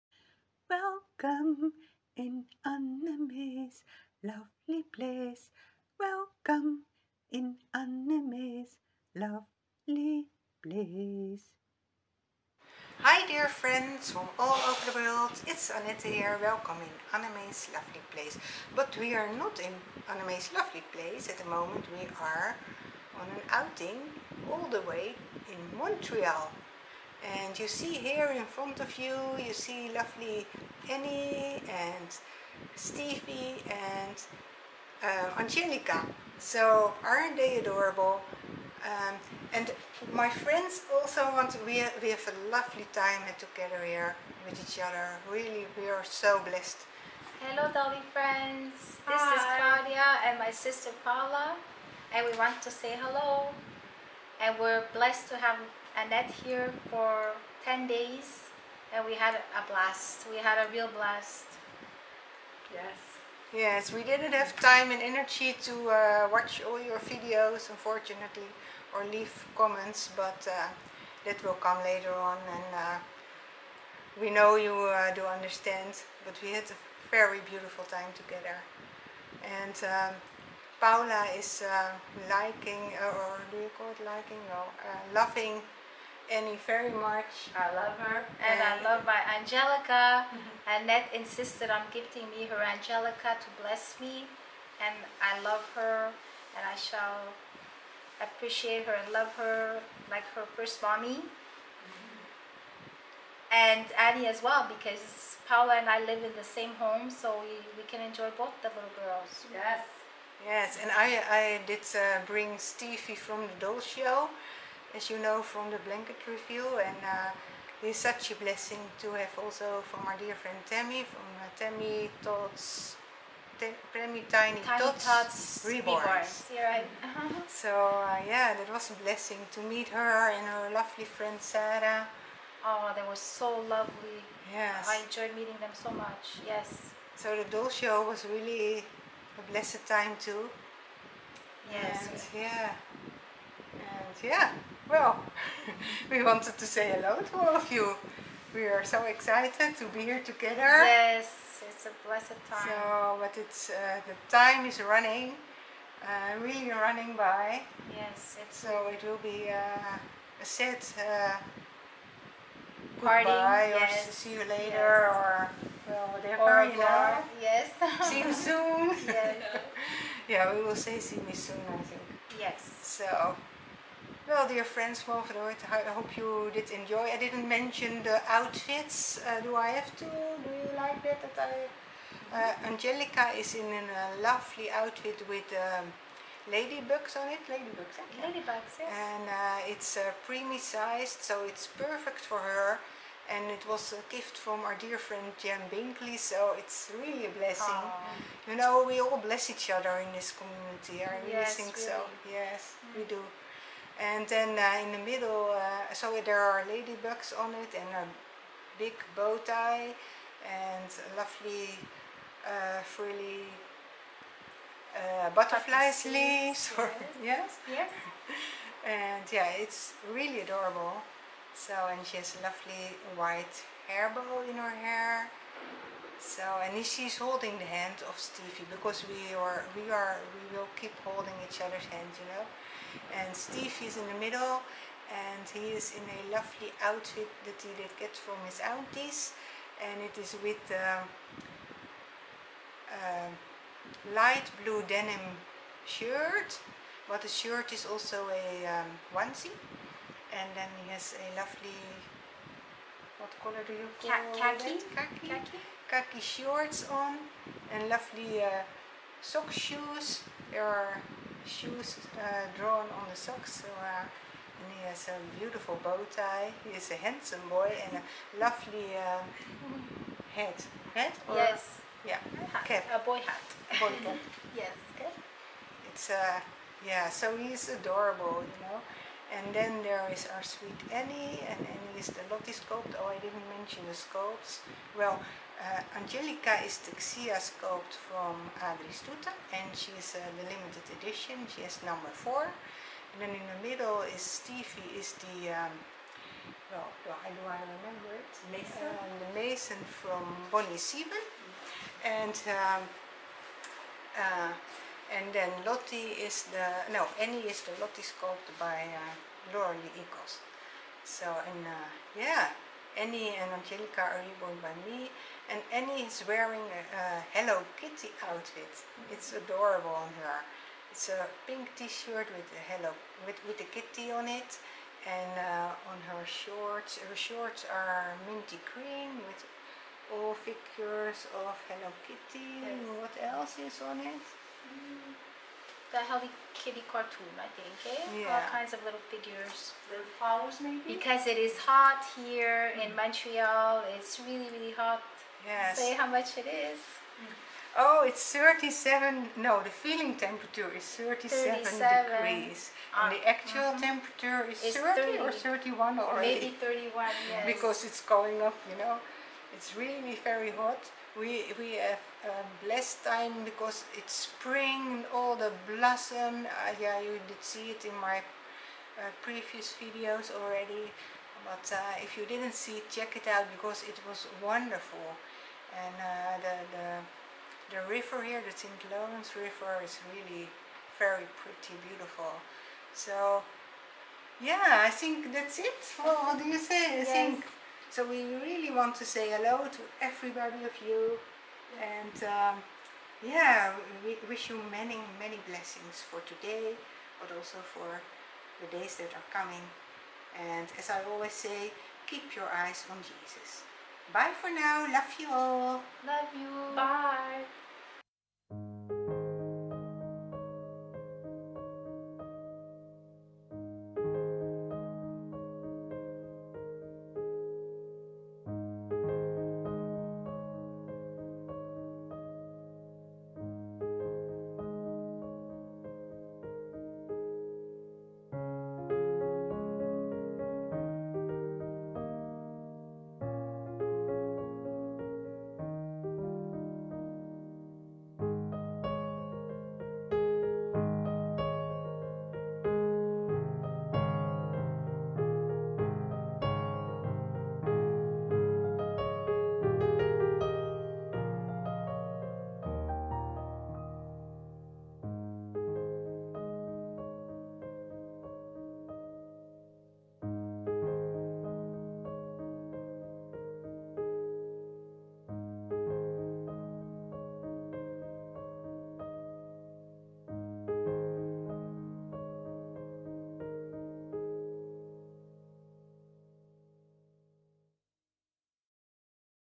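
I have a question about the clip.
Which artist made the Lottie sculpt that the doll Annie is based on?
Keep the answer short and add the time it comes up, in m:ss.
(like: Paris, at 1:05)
Laura Eagles, at 5:09.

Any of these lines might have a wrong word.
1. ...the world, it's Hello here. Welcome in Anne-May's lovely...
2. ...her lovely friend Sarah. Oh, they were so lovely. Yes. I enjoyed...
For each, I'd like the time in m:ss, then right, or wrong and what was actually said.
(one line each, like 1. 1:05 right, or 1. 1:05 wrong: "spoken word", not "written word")
1. 0:14 wrong: "Annette", not "Hello"
2. 2:10 right.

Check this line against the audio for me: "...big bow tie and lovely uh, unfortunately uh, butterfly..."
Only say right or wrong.
wrong.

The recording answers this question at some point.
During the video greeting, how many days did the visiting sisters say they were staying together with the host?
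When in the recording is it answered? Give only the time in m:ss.
0:57.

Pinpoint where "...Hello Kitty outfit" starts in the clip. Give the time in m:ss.
5:17.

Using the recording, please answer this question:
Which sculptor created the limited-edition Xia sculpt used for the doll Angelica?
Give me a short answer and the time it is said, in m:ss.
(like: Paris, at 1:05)
Adrie Stoete, at 4:48.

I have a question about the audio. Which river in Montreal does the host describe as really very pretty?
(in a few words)
St. Lawrence River.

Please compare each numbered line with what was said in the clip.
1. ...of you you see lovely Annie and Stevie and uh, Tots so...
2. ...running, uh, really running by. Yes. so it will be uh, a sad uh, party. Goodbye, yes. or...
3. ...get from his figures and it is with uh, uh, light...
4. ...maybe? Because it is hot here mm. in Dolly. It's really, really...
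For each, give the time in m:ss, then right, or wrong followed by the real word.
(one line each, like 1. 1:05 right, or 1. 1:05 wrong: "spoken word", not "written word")
1. 0:28 wrong: "Angelica", not "Tots"
2. 2:34 right
3. 3:57 wrong: "aunties", not "figures"
4. 5:40 wrong: "Montreal", not "Dolly".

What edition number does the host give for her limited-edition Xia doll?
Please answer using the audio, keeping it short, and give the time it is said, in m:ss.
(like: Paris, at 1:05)
4, at 4:51.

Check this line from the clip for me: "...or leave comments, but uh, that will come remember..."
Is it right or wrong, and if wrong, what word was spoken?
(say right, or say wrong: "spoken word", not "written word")
wrong: "later", not "remember".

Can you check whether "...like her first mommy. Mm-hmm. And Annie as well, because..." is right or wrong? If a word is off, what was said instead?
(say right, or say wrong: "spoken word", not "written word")
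right.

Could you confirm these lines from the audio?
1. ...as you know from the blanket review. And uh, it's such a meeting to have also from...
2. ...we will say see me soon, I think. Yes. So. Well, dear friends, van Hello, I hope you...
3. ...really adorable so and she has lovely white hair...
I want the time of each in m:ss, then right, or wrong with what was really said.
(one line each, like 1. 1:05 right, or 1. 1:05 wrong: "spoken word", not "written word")
1. 1:54 wrong: "blessing", not "meeting"
2. 2:50 wrong: "Verdoort", not "Hello"
3. 3:40 right.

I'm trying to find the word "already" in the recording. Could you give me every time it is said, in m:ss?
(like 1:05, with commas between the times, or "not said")
5:56, 6:10.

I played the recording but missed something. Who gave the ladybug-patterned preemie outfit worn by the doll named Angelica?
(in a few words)
Jan Binkley.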